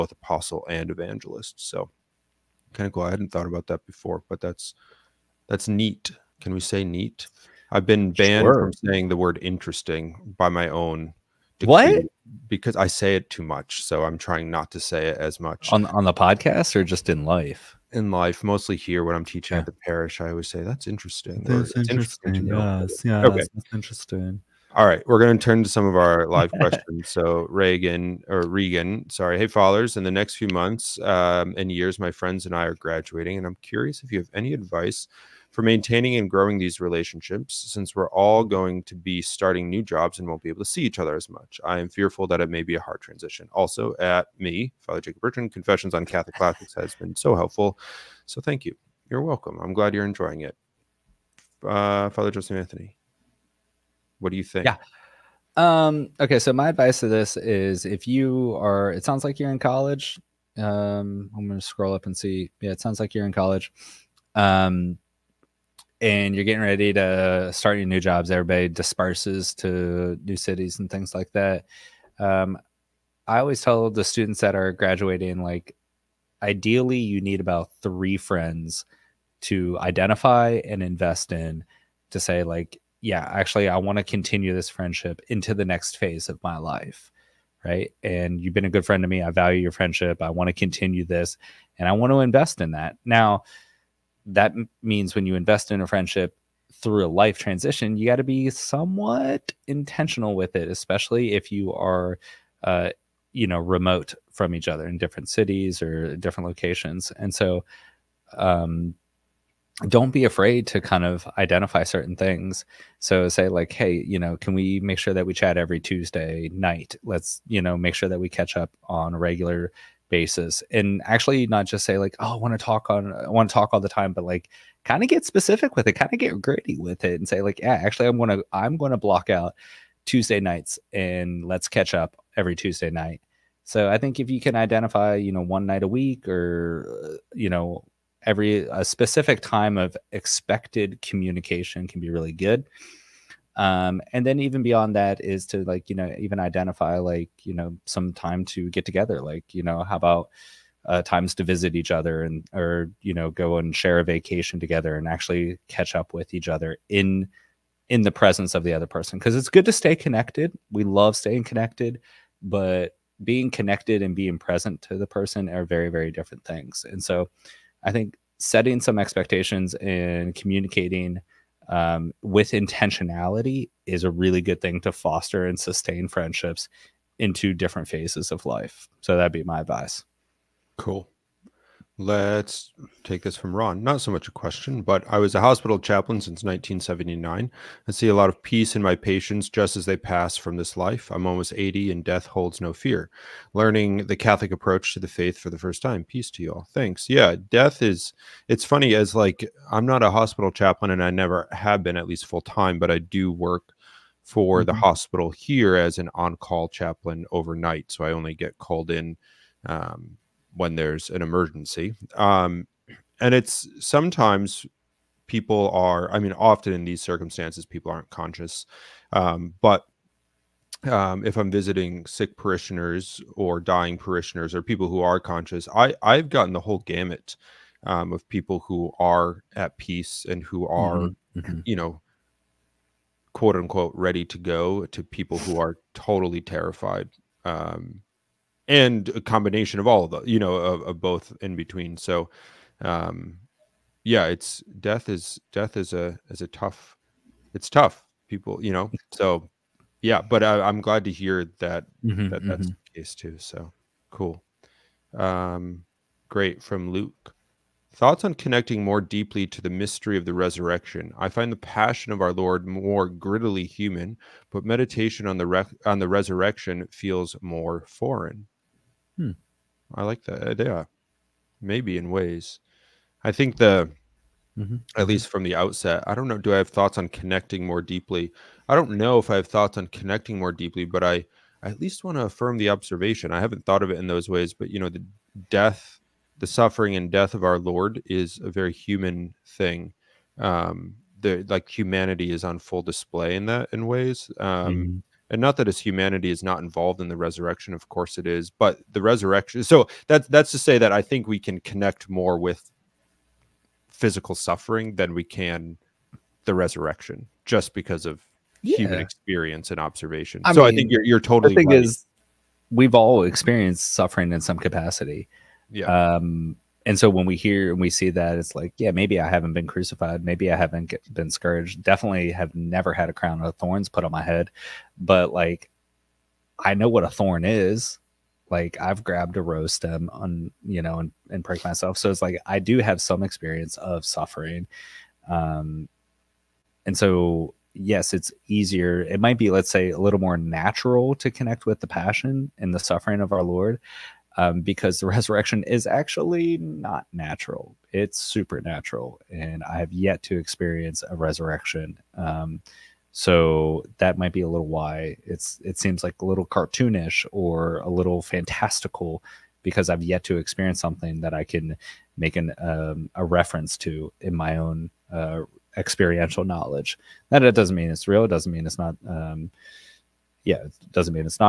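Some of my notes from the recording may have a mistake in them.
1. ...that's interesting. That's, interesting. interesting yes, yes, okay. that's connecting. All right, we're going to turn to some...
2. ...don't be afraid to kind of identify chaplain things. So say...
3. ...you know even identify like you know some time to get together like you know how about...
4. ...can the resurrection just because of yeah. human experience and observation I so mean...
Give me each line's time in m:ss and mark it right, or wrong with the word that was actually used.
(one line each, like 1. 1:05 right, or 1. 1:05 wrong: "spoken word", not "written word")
1. 0:20 wrong: "interesting", not "connecting"
2. 1:49 wrong: "certain", not "chaplain"
3. 2:25 right
4. 5:05 right.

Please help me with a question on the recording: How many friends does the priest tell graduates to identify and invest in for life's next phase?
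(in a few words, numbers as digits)
3.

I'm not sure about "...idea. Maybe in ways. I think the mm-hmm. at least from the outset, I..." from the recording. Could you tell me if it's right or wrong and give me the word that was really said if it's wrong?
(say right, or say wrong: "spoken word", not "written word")
right.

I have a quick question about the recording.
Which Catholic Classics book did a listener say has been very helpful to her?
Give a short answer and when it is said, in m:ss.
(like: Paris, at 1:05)
Confessions, at 0:45.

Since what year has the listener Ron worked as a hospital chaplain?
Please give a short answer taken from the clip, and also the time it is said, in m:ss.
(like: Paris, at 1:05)
1979, at 3:06.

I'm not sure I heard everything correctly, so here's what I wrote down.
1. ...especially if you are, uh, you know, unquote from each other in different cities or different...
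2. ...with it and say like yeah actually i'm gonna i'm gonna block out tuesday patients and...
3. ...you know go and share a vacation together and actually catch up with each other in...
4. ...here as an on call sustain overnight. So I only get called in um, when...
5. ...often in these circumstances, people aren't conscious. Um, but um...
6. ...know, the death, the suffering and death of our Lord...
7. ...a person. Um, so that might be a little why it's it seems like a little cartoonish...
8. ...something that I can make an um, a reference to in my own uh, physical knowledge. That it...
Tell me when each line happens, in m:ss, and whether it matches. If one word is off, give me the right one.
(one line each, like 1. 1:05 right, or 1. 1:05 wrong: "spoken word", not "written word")
1. 1:40 wrong: "remote", not "unquote"
2. 2:06 wrong: "nights", not "patients"
3. 2:33 right
4. 3:25 wrong: "chaplain", not "sustain"
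5. 3:36 right
6. 4:44 right
7. 5:51 wrong: "resurrection", not "person"
8. 6:00 wrong: "experiential", not "physical".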